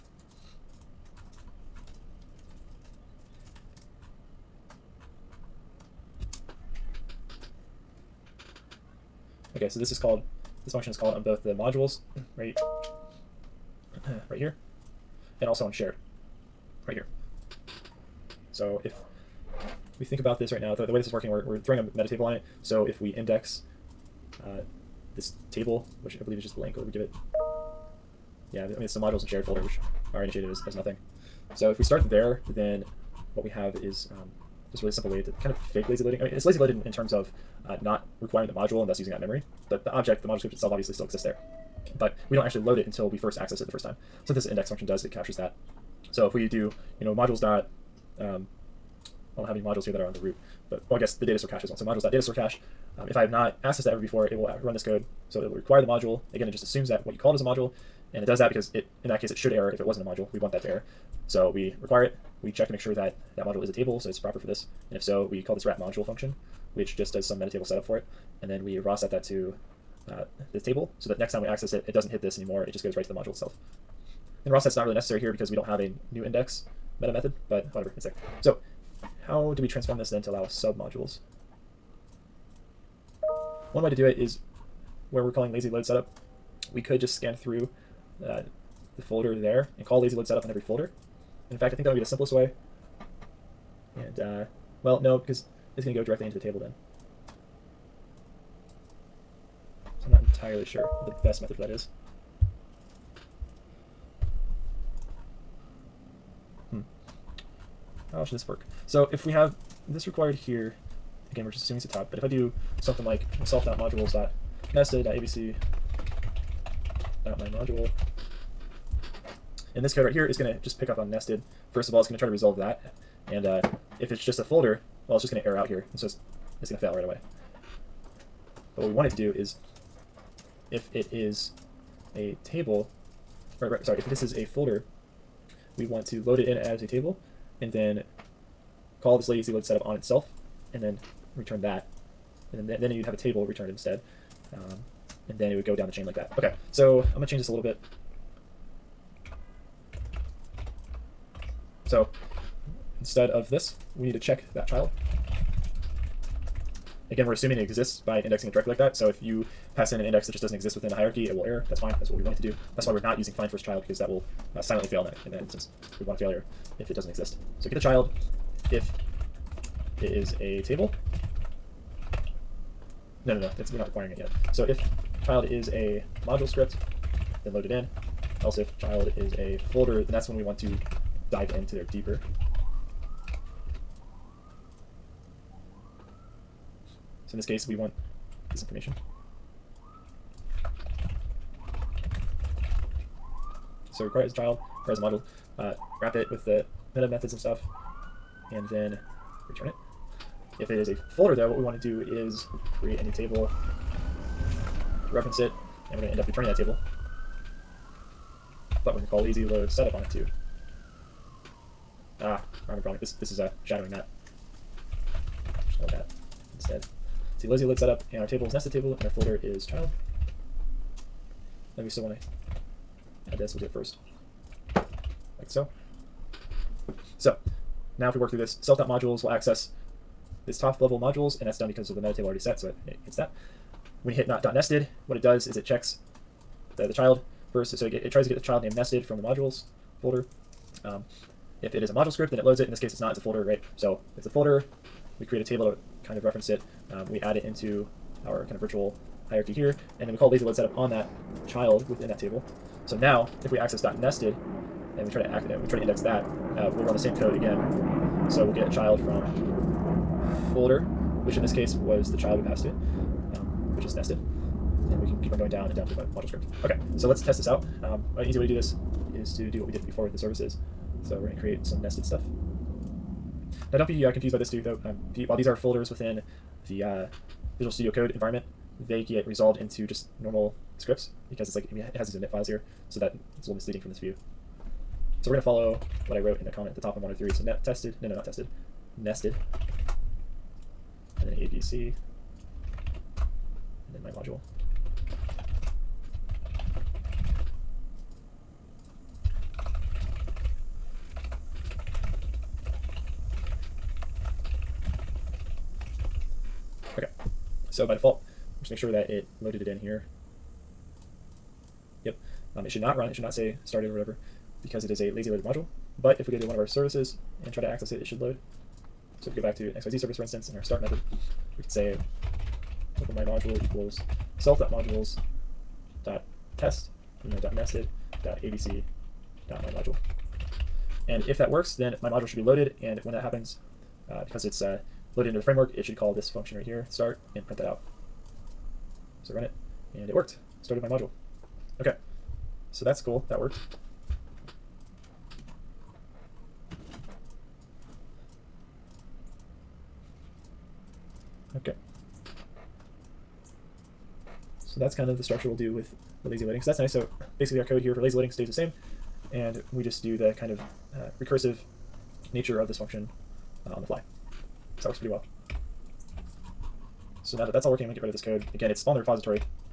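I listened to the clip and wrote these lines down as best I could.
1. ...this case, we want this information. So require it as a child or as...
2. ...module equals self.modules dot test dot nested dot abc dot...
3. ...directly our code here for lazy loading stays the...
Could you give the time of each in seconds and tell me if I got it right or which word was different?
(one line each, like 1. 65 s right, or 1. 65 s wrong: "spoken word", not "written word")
1. 187 s right
2. 323 s right
3. 357 s wrong: "basically", not "directly".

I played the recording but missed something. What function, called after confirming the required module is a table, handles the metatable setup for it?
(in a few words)
wrap module.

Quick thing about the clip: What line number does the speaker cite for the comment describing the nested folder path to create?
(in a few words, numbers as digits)
103.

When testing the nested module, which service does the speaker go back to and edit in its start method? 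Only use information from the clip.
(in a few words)
XYZ service.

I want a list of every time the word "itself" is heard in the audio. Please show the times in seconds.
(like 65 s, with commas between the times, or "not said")
40 s, 73 s, 139 s.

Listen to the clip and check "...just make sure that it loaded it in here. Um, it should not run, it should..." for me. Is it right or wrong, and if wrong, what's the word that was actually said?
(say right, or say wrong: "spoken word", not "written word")
right.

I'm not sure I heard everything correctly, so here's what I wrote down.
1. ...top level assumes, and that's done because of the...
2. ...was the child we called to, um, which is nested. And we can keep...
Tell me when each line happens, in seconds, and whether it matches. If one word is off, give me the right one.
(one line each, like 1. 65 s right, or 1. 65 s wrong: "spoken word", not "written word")
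1. 230 s wrong: "modules", not "assumes"
2. 261 s wrong: "passed", not "called".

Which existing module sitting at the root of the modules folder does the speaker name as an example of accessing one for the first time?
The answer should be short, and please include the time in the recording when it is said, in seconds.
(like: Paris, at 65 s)
data store cache, at 51 s.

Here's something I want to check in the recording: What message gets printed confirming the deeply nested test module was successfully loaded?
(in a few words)
Started my module.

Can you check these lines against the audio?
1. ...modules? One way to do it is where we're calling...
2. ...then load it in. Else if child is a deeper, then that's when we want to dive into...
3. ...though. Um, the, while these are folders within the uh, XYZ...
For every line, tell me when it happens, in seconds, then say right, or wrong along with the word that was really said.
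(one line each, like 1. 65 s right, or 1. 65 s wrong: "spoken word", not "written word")
1. 80 s right
2. 177 s wrong: "folder", not "deeper"
3. 274 s wrong: "Visual", not "XYZ".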